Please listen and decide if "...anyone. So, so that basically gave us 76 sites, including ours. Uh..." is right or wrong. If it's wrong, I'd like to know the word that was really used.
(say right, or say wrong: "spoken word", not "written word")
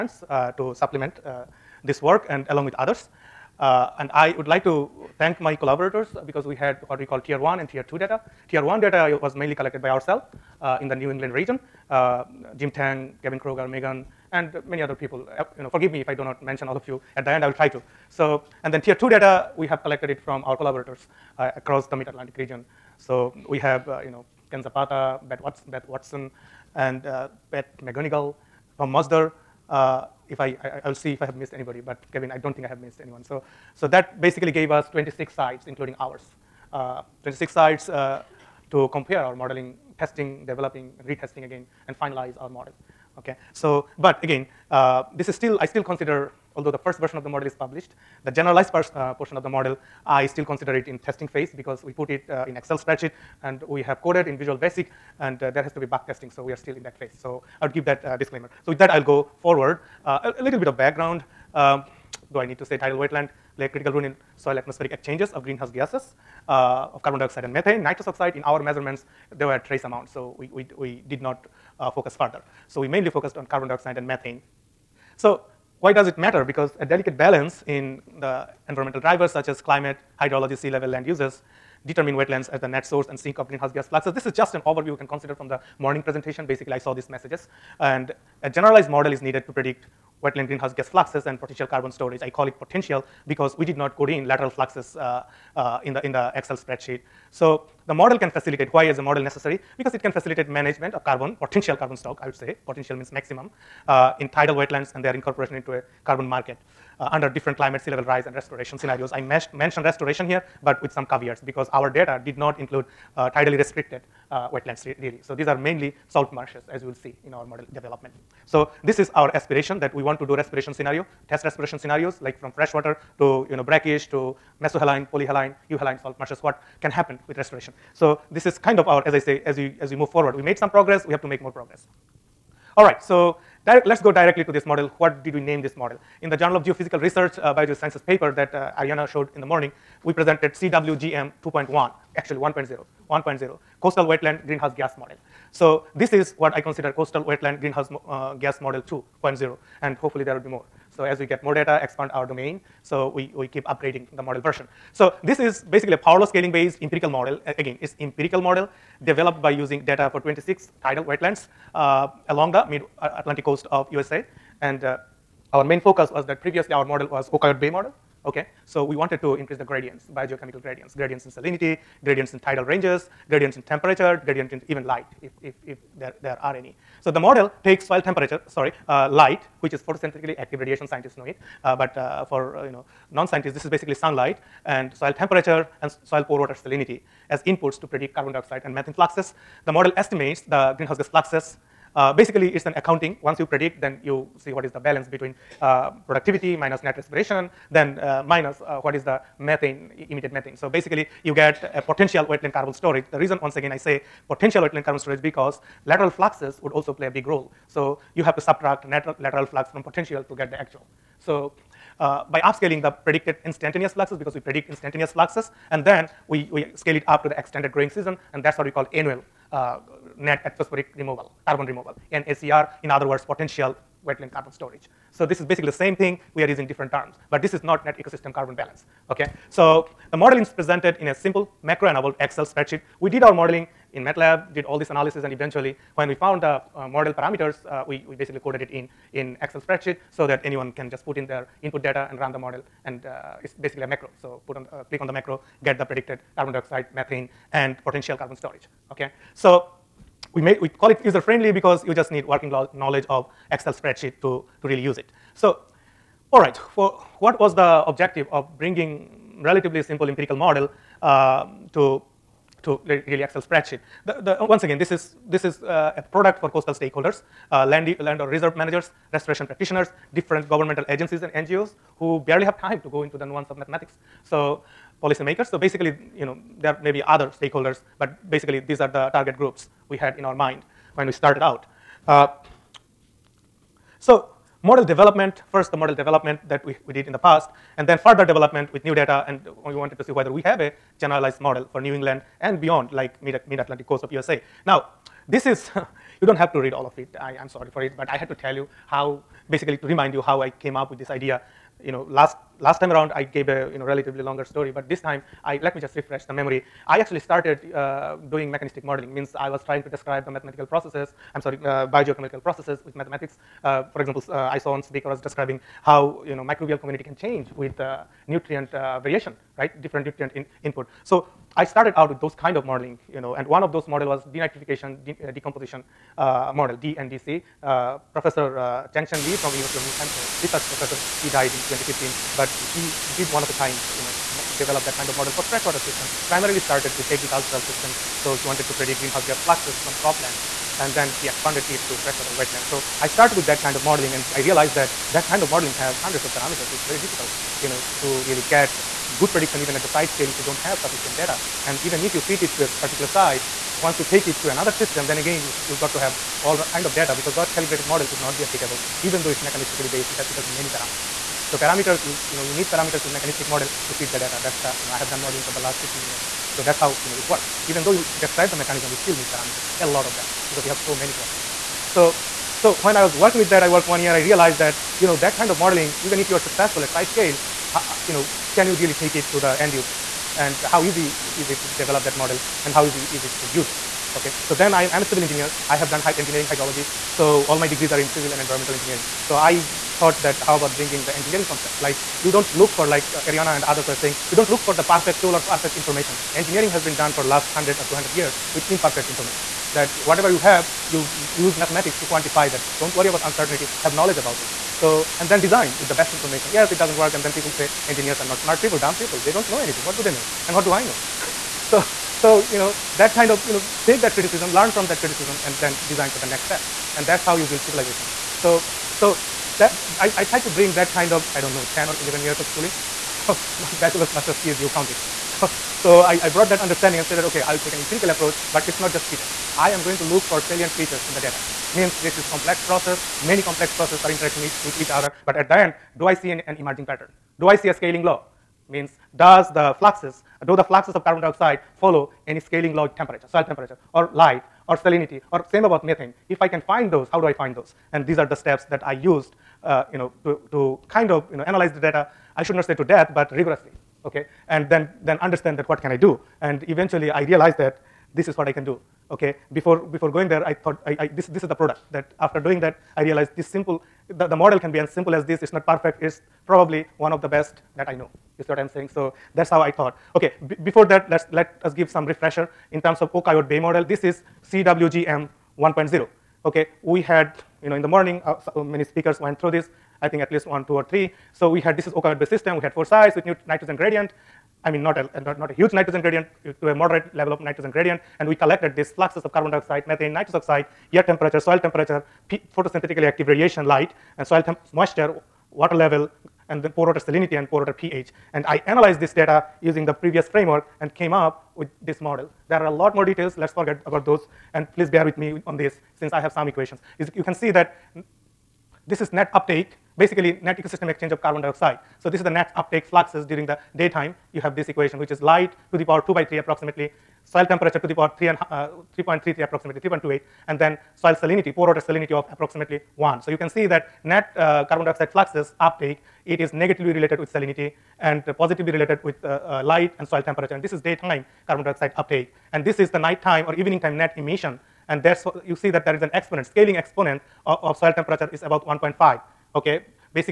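wrong: "26", not "76".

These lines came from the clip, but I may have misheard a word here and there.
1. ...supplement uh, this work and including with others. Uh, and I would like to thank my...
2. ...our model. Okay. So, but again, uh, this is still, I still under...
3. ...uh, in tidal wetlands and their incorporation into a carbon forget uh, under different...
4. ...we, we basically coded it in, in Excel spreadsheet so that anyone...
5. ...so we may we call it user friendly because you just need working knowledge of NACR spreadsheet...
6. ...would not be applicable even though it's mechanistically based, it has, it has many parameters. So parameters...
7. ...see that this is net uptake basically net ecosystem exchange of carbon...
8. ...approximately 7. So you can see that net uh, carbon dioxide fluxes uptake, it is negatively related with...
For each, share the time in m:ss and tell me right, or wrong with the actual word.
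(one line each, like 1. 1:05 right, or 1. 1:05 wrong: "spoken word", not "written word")
1. 0:00 wrong: "along", not "including"
2. 0:42 wrong: "consider", not "under"
3. 1:43 wrong: "market", not "forget"
4. 3:57 right
5. 4:09 wrong: "Excel", not "NACR"
6. 5:58 right
7. 8:27 right
8. 8:42 wrong: "1", not "7".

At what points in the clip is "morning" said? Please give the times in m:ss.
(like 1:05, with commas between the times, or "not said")
1:25, 2:19, 7:57.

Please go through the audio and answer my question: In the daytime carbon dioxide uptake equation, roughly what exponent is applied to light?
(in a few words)
2/3.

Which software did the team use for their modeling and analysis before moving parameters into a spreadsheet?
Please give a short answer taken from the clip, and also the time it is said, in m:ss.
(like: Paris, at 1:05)
MATLAB, at 3:54.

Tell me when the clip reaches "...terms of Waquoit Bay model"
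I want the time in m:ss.
7:52.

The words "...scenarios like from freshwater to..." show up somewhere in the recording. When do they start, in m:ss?
2:01.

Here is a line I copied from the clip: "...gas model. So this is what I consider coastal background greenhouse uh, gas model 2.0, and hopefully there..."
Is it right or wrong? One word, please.
wrong.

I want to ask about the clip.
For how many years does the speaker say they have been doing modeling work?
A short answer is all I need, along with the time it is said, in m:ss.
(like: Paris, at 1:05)
15 years, at 6:05.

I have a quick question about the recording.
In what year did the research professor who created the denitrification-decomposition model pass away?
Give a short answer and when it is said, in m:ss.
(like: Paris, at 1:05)
2015, at 5:31.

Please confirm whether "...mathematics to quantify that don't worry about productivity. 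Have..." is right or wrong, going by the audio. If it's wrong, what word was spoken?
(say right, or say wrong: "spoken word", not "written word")
wrong: "uncertainty", not "productivity".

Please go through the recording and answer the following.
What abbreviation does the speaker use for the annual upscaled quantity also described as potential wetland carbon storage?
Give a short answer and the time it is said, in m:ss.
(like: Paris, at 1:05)
NACR, at 3:42.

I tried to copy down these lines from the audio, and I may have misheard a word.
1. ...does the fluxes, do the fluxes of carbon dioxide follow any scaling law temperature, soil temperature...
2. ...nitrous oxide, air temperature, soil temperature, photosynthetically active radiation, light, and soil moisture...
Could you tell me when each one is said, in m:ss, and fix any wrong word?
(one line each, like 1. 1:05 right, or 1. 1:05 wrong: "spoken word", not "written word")
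1. 7:19 right
2. 8:10 right.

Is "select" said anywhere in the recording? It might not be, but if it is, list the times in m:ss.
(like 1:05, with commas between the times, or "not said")
not said.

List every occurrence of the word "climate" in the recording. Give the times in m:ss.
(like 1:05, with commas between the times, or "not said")
1:19, 1:47.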